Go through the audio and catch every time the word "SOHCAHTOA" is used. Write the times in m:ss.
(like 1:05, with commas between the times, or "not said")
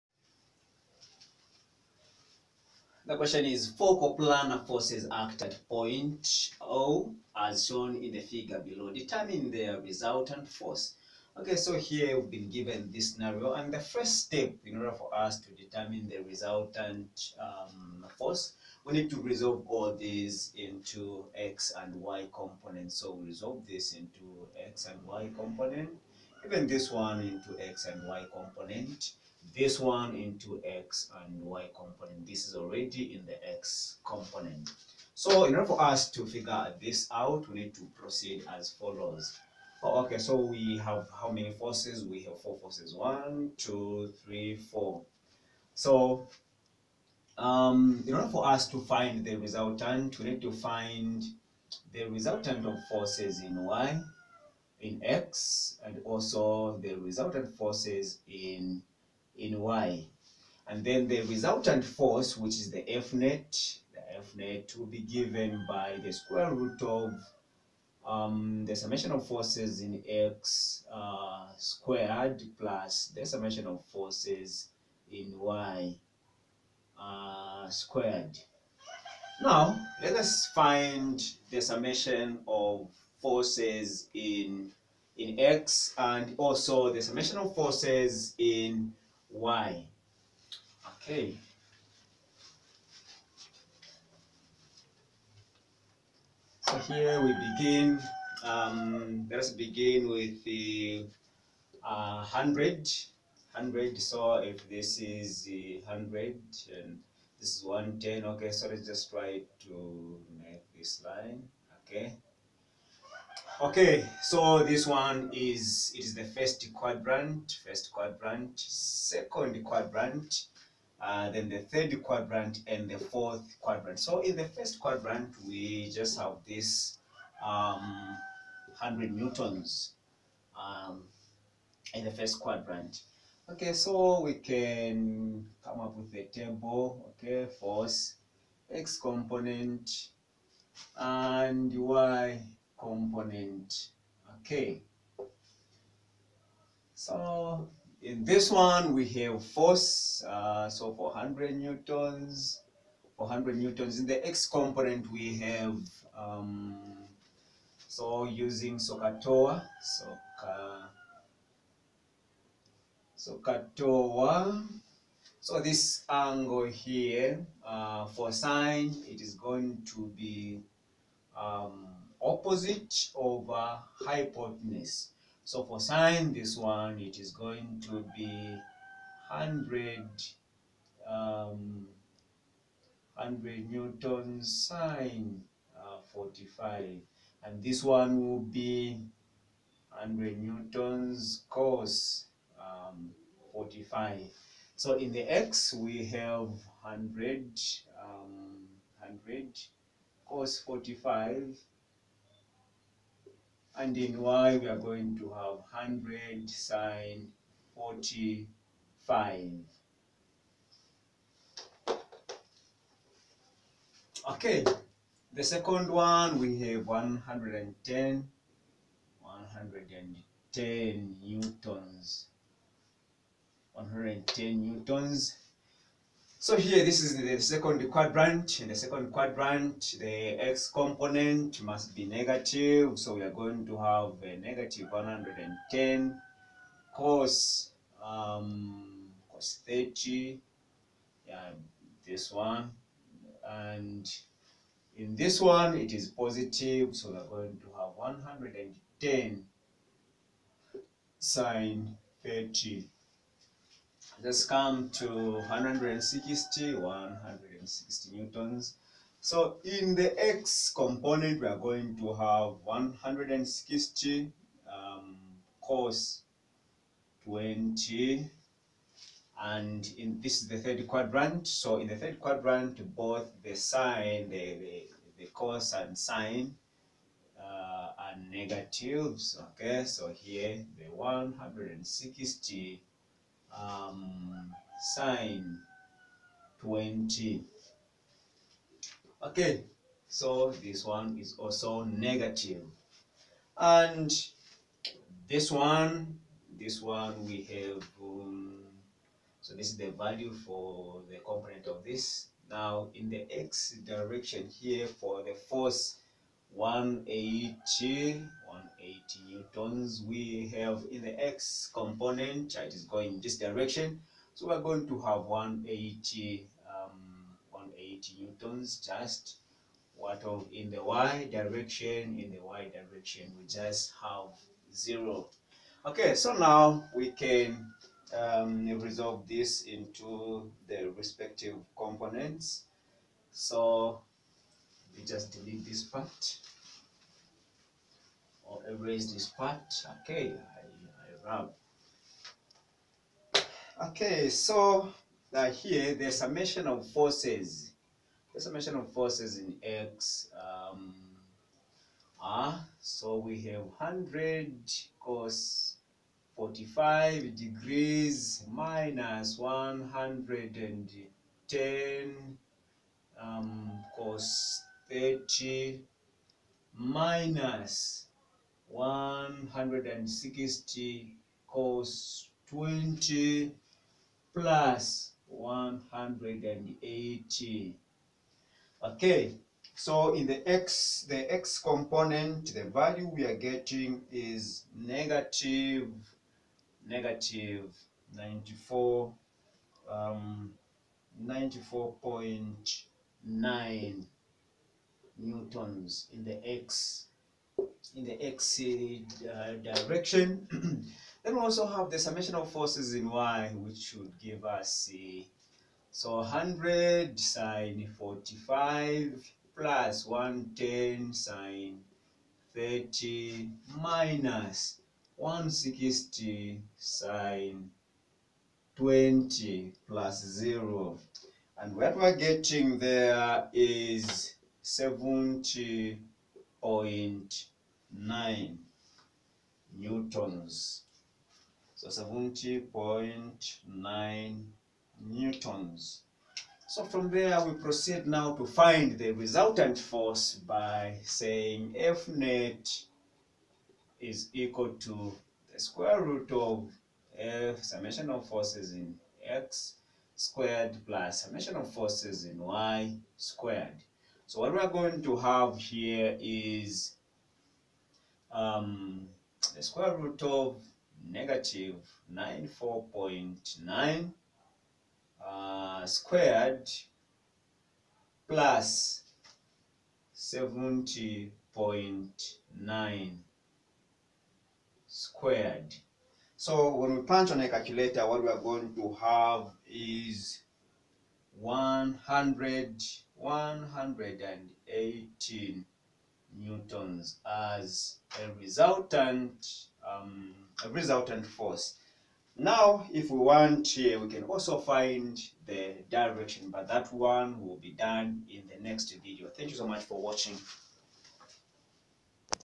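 2:38, 2:43.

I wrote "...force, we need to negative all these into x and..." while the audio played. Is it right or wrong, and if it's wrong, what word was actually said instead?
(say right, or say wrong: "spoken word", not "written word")
wrong: "resolve", not "negative".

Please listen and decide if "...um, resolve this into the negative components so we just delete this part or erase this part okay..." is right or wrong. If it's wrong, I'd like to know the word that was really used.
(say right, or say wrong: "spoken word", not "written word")
wrong: "respective", not "negative".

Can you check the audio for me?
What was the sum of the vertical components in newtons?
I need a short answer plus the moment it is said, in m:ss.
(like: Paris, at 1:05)
70.9 N, at 7:11.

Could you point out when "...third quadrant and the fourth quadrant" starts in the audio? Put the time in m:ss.
2:01.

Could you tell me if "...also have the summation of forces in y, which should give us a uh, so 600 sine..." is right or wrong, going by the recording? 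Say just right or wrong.
wrong.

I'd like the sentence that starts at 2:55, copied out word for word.
So for sine, this one, it is going to be 100, um, 100 newton sine uh, 45.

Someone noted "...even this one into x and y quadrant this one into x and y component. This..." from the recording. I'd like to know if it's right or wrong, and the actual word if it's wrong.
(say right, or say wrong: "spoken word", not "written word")
wrong: "component", not "quadrant".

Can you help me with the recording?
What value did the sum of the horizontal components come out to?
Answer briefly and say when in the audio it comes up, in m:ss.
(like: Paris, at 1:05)
-94.9 N, at 6:26.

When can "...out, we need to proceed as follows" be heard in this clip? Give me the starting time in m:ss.
0:37.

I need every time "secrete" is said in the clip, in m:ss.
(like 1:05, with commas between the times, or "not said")
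not said.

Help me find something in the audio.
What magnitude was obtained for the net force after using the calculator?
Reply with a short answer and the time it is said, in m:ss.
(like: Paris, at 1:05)
118 N, at 8:03.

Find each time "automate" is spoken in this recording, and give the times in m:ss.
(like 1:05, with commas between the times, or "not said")
not said.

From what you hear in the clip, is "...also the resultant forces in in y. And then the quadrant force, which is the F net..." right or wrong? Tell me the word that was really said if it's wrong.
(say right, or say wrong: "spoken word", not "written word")
wrong: "resultant", not "quadrant".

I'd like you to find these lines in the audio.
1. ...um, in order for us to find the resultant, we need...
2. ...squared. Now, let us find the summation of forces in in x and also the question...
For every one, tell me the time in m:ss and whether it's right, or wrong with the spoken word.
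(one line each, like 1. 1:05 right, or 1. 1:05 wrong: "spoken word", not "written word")
1. 0:47 right
2. 1:17 wrong: "summation", not "question".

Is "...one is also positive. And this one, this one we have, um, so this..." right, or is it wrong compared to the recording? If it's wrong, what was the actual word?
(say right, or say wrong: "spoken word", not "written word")
wrong: "negative", not "positive".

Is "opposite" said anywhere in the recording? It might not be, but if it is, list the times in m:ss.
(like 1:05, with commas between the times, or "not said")
2:52.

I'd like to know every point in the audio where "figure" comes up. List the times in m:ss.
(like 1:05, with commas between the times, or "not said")
0:08, 0:36.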